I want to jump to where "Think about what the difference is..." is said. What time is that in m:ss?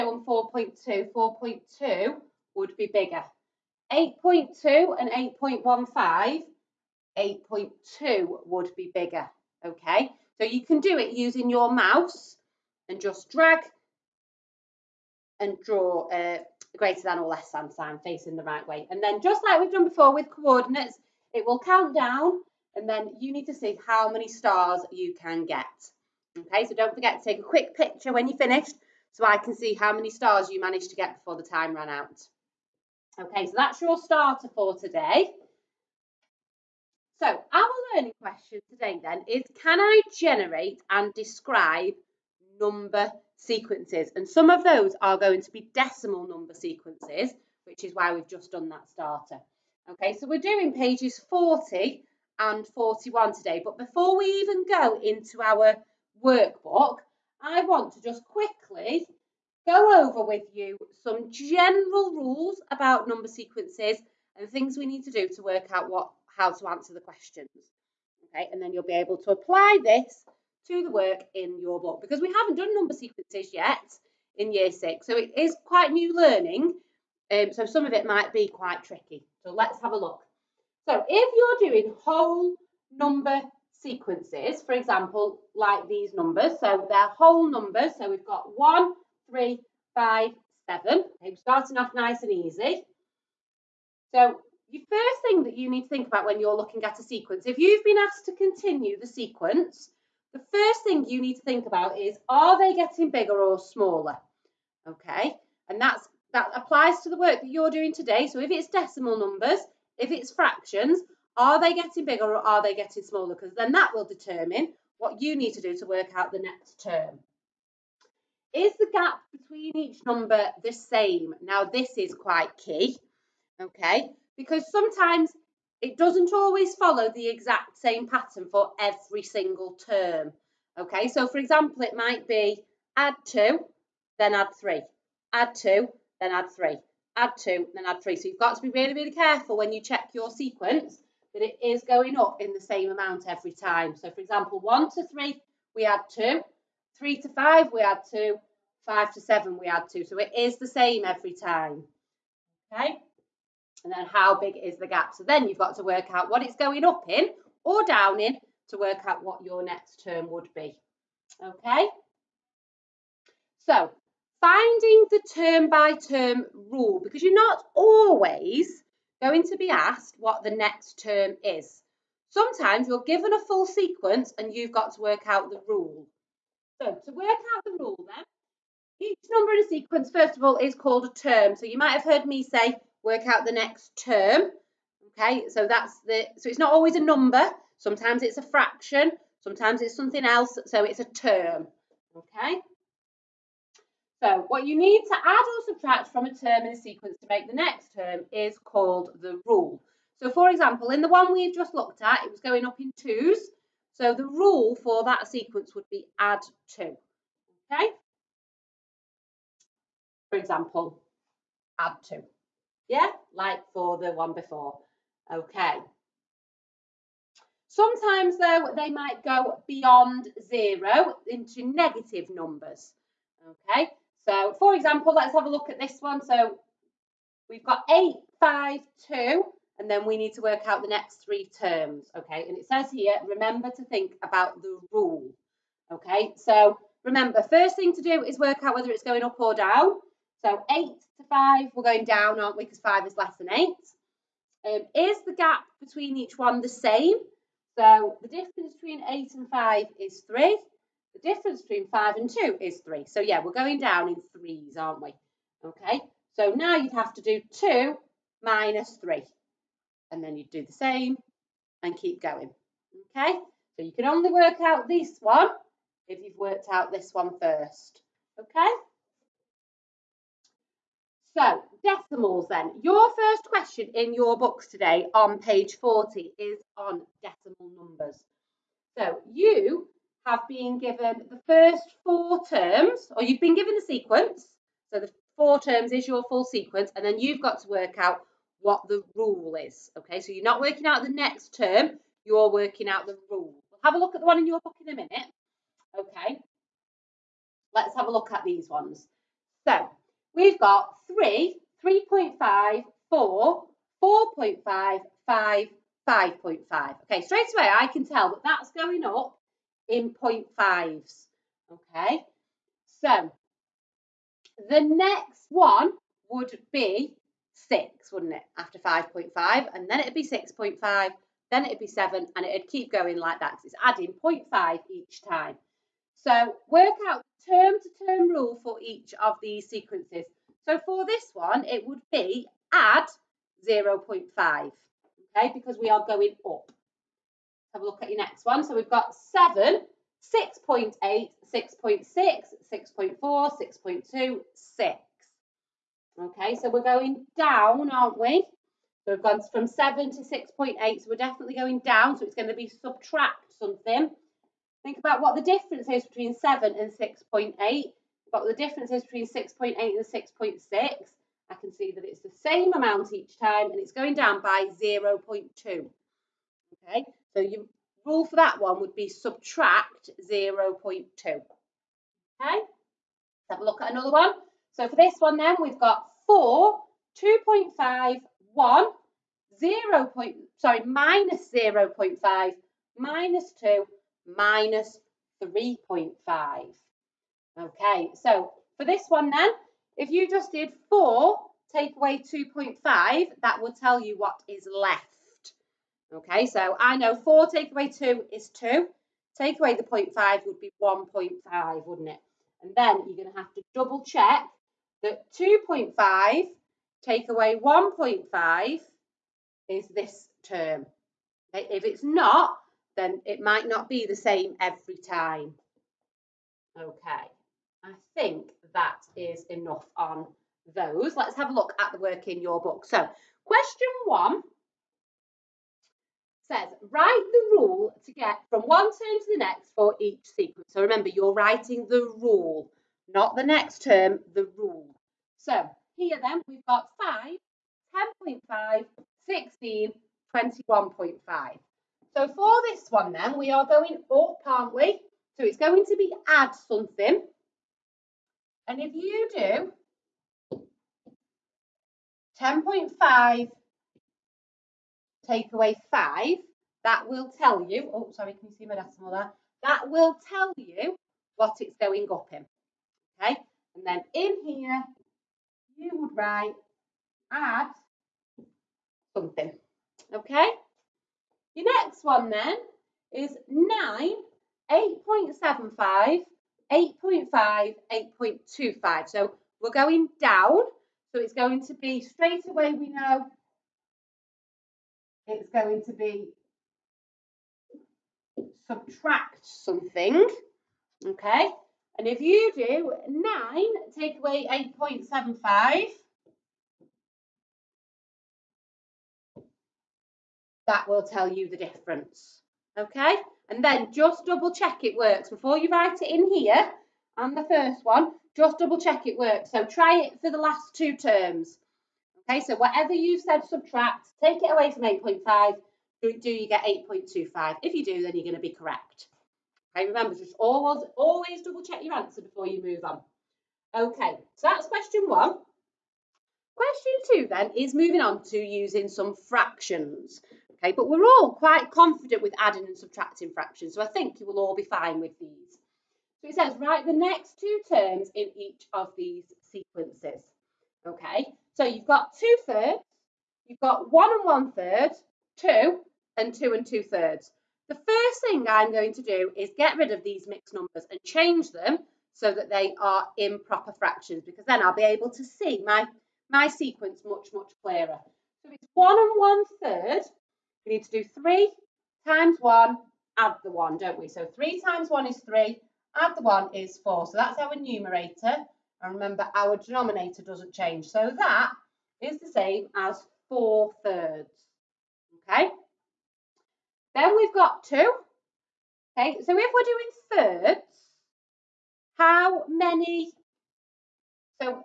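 5:54.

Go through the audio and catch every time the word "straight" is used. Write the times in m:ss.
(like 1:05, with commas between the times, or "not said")
5:07, 8:02.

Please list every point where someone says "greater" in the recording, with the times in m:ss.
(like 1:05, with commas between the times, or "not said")
0:16.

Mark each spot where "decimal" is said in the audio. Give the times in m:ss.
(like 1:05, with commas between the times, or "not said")
0:45, 1:48, 4:31, 4:37, 7:38.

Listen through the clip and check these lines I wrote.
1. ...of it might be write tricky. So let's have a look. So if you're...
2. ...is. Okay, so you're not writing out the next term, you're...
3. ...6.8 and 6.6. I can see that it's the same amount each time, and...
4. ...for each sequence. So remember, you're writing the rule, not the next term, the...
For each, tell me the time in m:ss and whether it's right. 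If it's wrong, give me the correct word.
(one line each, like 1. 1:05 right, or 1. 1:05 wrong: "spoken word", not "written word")
1. 1:17 wrong: "quite", not "write"
2. 4:49 wrong: "working", not "writing"
3. 5:59 right
4. 7:09 right.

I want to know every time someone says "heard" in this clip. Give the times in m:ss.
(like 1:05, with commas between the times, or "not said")
3:02.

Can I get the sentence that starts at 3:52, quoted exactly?
And it says here, remember to think about the rule, okay?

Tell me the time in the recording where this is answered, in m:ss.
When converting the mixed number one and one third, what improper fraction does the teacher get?
9:33.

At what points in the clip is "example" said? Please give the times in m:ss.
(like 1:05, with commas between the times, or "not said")
1:24, 2:11, 2:24, 3:20, 3:30, 3:44.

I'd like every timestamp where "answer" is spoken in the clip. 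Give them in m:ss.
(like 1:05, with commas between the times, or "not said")
1:06, 8:41.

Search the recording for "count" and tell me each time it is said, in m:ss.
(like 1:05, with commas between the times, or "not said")
0:21.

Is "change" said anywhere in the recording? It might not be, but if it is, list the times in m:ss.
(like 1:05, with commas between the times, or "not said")
9:11, 9:30.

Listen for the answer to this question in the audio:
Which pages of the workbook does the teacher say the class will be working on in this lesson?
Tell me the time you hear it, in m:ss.
0:50.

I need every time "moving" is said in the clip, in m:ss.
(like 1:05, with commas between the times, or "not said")
8:47.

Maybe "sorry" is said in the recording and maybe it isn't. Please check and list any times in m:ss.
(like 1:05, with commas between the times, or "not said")
6:20, 7:38.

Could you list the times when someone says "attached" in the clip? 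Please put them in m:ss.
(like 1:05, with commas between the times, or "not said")
not said.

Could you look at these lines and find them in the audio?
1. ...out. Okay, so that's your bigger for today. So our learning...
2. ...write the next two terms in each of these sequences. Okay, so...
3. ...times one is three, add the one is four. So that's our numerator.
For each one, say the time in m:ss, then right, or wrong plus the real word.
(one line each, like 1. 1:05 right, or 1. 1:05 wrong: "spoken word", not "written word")
1. 0:31 wrong: "starter", not "bigger"
2. 8:56 right
3. 9:24 right.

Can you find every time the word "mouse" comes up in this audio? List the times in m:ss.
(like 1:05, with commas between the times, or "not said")
0:11.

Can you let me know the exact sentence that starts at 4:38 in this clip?
So, you have been given the first four terms, or you've been given the sequence.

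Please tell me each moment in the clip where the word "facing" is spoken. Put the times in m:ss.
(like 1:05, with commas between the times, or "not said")
0:18.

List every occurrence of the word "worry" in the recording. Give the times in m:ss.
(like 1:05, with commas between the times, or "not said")
not said.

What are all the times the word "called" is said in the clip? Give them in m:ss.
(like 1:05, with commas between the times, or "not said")
3:00, 3:18.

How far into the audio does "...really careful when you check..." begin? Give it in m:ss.
2:18.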